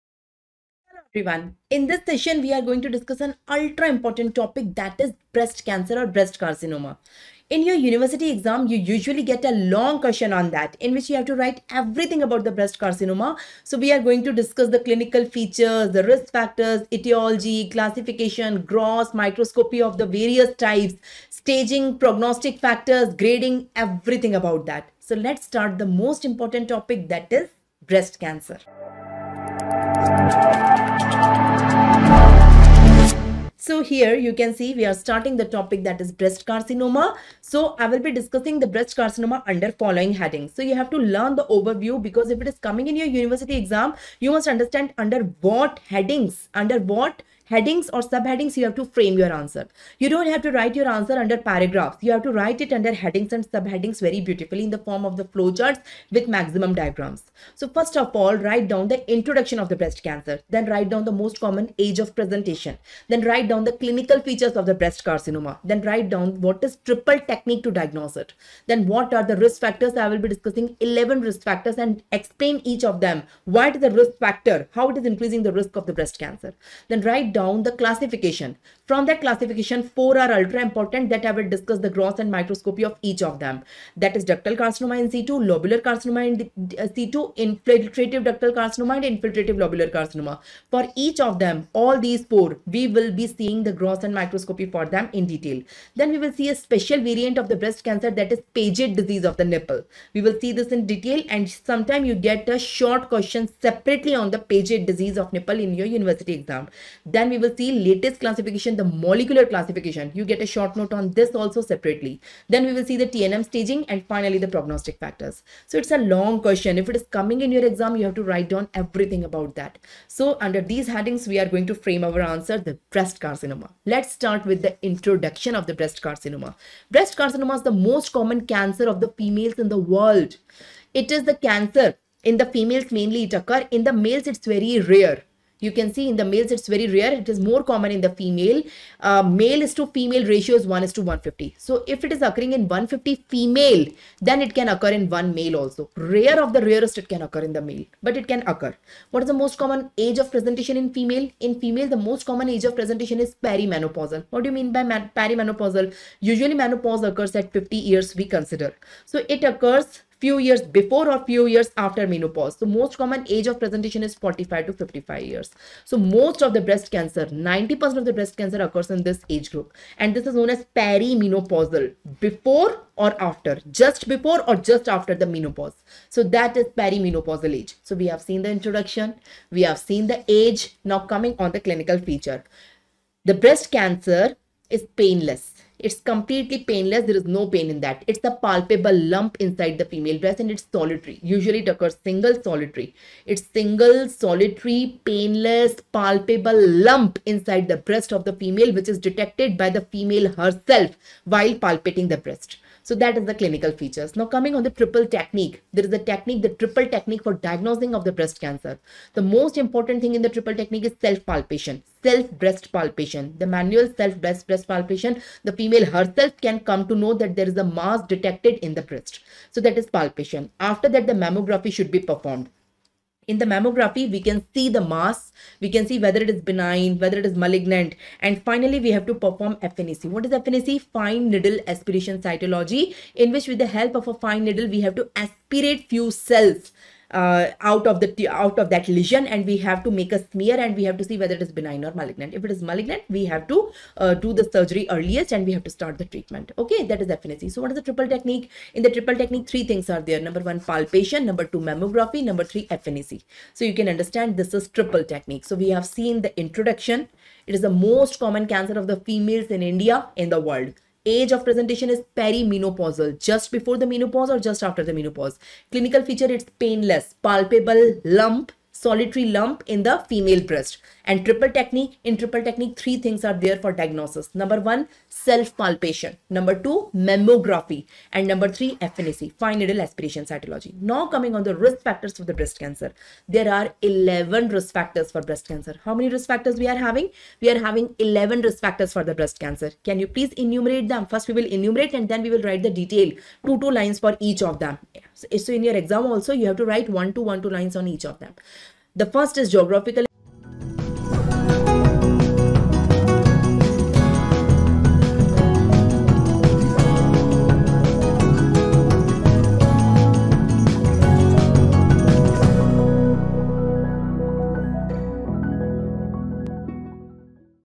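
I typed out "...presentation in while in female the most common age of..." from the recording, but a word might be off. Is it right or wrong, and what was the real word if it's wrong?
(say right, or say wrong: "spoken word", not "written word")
wrong: "female", not "while".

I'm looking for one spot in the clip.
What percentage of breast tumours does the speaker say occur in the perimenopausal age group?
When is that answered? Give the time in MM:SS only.
02:47.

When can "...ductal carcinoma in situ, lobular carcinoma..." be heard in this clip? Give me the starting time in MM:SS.
01:24.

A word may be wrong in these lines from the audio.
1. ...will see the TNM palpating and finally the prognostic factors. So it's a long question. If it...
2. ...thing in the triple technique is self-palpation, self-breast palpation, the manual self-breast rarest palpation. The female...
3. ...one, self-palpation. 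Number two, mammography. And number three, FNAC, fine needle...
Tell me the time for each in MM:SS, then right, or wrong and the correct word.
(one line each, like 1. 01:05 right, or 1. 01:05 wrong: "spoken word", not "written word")
1. 01:52 wrong: "staging", not "palpating"
2. 03:30 wrong: "breast", not "rarest"
3. 04:34 right.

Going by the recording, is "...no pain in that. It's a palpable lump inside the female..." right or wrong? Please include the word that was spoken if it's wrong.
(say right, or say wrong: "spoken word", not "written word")
right.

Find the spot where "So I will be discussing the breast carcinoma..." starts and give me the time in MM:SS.
00:37.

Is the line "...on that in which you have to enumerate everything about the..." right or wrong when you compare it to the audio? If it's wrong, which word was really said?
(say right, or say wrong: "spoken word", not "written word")
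wrong: "write", not "enumerate".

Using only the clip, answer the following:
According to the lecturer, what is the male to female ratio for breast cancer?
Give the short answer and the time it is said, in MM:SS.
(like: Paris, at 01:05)
1:150, at 02:20.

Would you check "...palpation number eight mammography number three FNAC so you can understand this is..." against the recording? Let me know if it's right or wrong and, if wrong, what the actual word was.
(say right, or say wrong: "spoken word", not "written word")
wrong: "two", not "eight".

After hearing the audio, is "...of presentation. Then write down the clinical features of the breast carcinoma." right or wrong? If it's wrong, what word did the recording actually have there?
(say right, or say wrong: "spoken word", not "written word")
right.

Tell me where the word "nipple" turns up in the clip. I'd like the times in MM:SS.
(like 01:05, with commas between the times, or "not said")
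01:39, 01:45.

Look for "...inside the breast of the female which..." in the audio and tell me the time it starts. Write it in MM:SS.
03:17.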